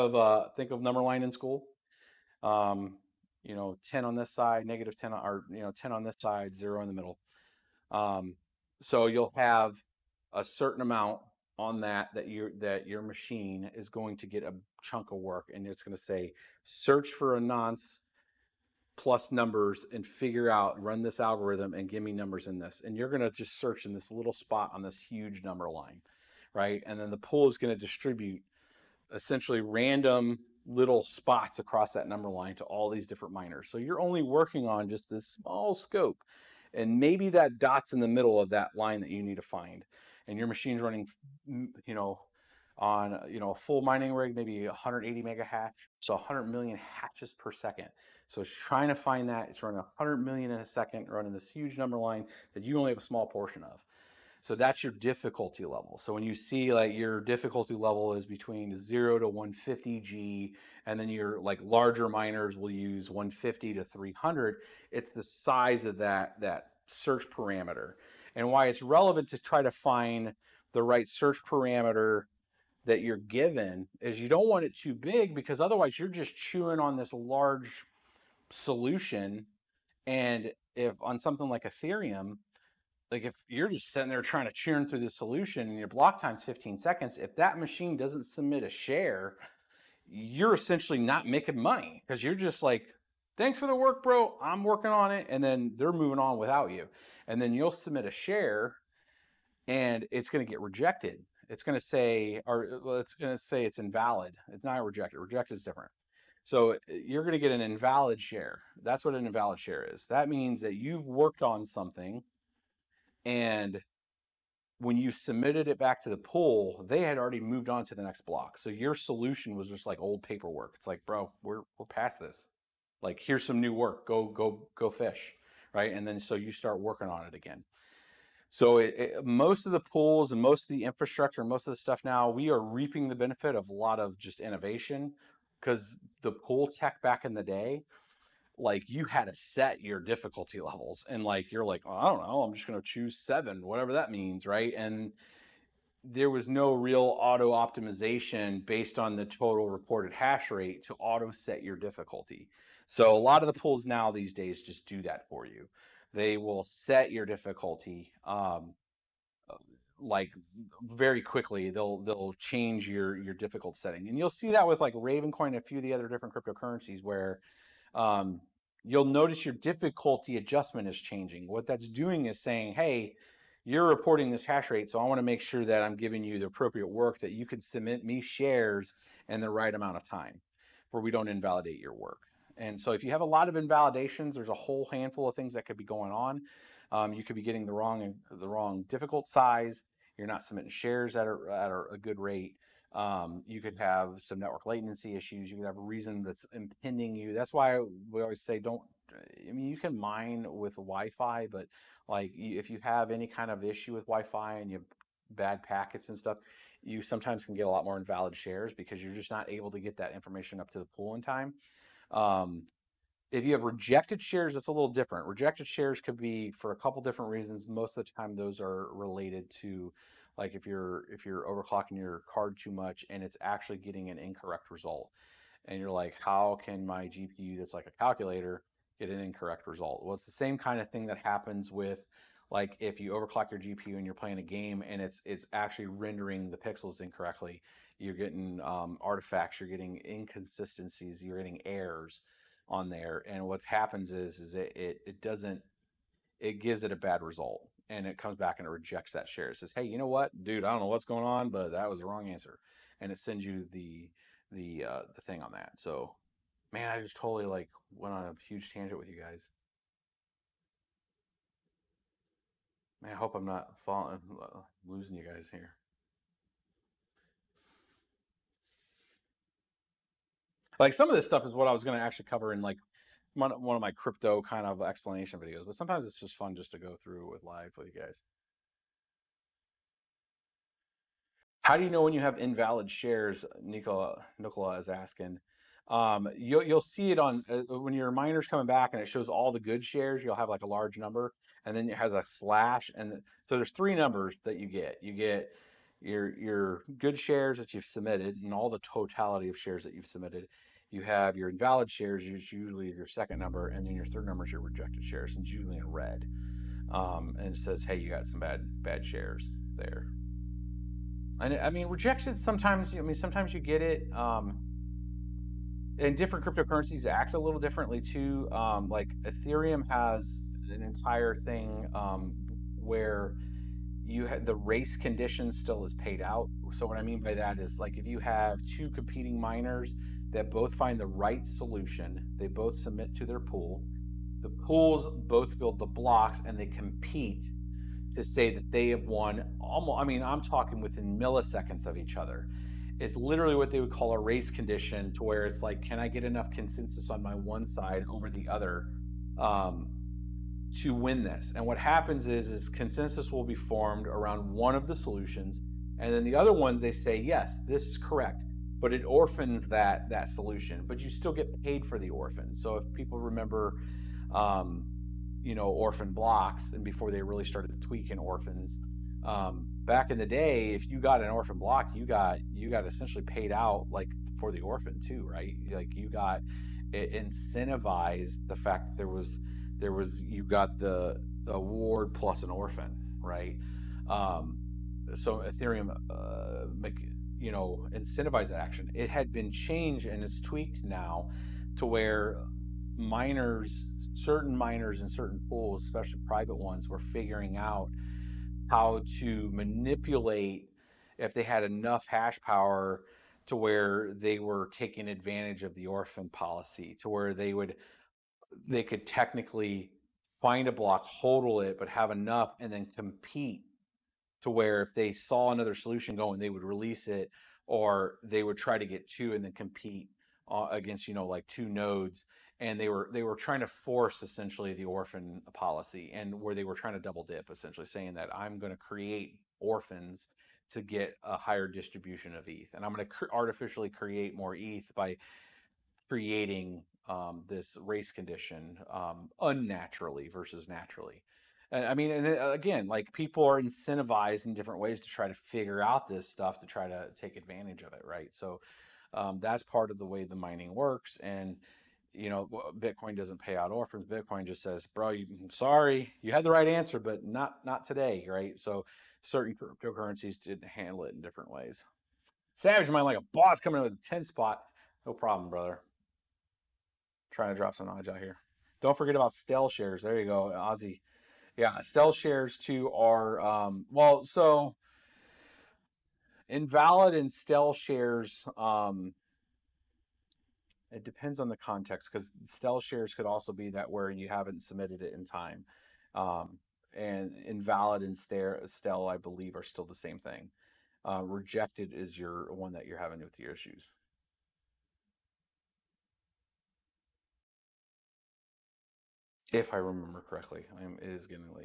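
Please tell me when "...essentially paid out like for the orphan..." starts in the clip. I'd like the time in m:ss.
6:12.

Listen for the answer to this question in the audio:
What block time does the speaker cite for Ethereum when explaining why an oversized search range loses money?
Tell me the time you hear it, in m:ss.
1:26.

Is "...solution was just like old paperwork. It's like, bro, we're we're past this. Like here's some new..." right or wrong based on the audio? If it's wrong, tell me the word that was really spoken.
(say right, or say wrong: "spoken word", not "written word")
right.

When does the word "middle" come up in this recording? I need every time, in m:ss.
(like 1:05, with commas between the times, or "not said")
0:06, 0:38.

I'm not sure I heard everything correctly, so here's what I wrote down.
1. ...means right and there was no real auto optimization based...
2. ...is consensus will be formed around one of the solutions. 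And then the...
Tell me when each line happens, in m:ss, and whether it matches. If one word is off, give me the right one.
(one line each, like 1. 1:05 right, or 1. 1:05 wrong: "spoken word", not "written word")
1. 2:24 right
2. 5:52 right.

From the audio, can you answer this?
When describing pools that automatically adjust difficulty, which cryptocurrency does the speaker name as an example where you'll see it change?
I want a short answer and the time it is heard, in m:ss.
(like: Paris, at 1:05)
Ravencoin, at 2:44.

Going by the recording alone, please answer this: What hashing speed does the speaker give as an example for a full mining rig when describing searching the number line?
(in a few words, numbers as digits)
180 megahash.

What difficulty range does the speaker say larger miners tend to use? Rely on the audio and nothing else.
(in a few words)
150 to 300.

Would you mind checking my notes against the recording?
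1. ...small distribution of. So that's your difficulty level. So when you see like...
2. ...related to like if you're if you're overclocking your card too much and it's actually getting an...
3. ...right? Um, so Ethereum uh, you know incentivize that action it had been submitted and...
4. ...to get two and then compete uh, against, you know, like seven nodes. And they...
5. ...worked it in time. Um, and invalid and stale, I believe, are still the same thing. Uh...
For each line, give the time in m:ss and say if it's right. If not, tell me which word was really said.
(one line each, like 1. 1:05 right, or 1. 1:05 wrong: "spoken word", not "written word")
1. 0:53 wrong: "portion", not "distribution"
2. 3:38 right
3. 6:23 wrong: "changed", not "submitted"
4. 6:58 wrong: "two", not "seven"
5. 8:04 wrong: "submitted", not "worked".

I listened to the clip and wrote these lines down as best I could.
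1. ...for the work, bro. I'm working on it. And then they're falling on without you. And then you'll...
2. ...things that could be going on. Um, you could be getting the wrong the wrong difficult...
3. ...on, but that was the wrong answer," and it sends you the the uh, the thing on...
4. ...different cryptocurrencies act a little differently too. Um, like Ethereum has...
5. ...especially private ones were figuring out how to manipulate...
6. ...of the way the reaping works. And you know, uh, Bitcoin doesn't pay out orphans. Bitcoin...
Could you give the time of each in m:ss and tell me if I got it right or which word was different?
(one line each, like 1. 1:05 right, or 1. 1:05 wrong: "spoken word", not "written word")
1. 1:33 wrong: "moving", not "falling"
2. 3:05 right
3. 4:11 right
4. 5:16 right
5. 6:35 right
6. 7:29 wrong: "mining", not "reaping".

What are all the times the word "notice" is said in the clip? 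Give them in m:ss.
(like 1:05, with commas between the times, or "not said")
2:49.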